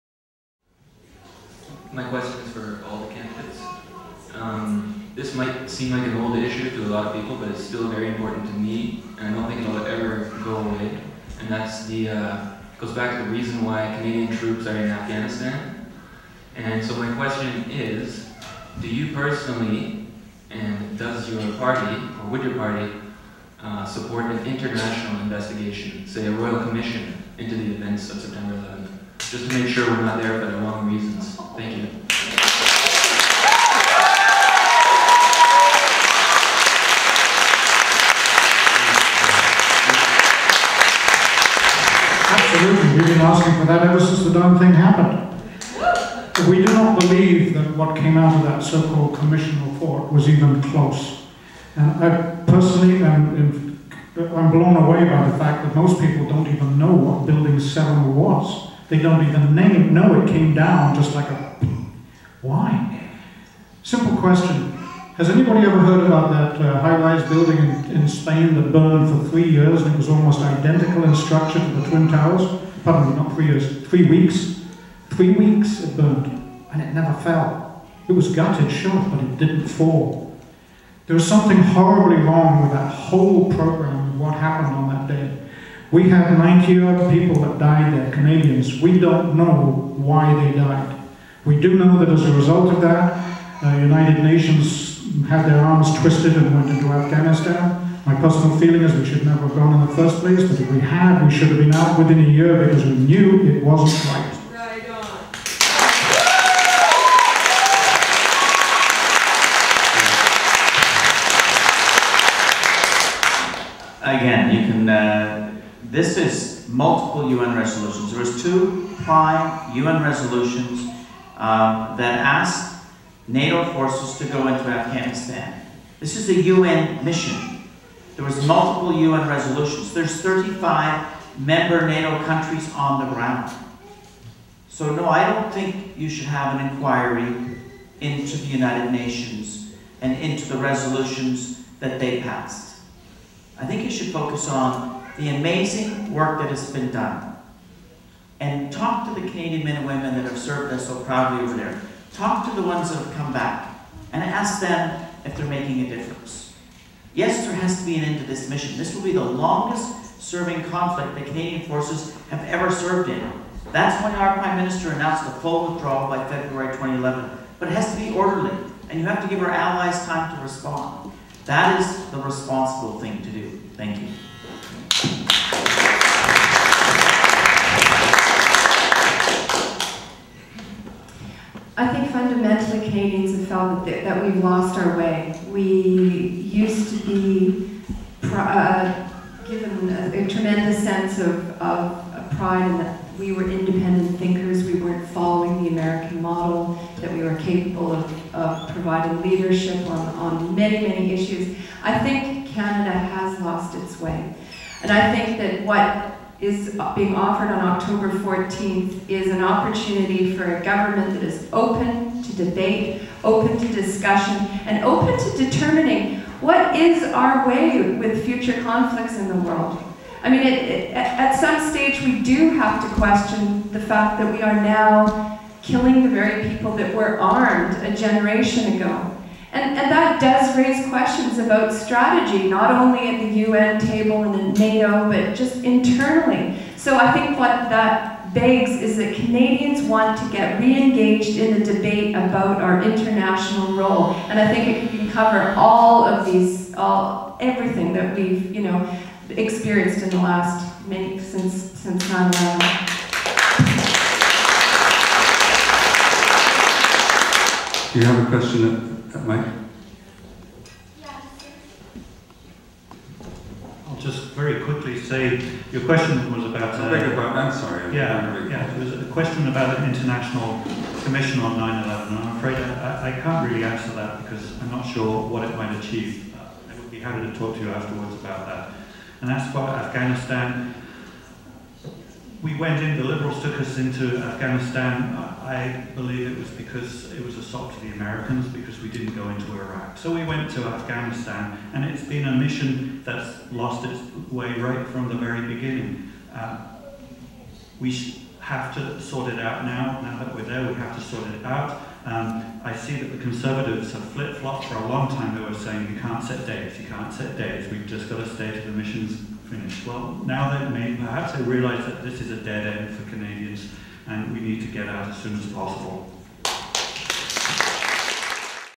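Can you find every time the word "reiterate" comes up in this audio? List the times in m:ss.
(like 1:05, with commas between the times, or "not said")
not said.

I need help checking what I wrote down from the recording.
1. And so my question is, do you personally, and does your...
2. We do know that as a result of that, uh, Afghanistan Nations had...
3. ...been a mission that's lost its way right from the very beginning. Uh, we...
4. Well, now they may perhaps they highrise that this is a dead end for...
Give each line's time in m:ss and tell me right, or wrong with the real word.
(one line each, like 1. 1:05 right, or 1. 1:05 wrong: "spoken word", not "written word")
1. 0:16 right
2. 1:31 wrong: "United", not "Afghanistan"
3. 4:52 right
4. 5:09 wrong: "realise", not "highrise".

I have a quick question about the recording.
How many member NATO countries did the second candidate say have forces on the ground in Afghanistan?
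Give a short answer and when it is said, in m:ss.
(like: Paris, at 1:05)
35, at 2:10.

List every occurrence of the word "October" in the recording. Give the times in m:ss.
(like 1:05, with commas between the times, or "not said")
3:27.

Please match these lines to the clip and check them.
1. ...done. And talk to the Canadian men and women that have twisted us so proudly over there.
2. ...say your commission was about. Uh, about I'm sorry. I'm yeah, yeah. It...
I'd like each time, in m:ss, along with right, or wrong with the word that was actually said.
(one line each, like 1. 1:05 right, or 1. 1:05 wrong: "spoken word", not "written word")
1. 2:26 wrong: "served", not "twisted"
2. 4:24 wrong: "question", not "commission".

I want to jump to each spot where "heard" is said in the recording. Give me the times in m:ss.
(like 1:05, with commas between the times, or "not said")
1:05.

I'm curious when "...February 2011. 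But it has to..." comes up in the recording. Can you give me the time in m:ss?
2:46.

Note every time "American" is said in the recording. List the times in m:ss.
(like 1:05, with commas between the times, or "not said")
3:15, 4:47.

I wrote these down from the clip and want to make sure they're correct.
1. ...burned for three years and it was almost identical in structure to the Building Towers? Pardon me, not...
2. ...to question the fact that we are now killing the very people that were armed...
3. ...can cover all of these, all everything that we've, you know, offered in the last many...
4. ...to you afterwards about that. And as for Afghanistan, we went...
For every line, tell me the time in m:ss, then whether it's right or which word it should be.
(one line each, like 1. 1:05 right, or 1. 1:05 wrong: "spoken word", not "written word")
1. 1:08 wrong: "Twin", not "Building"
2. 3:42 right
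3. 4:04 wrong: "experienced", not "offered"
4. 4:37 right.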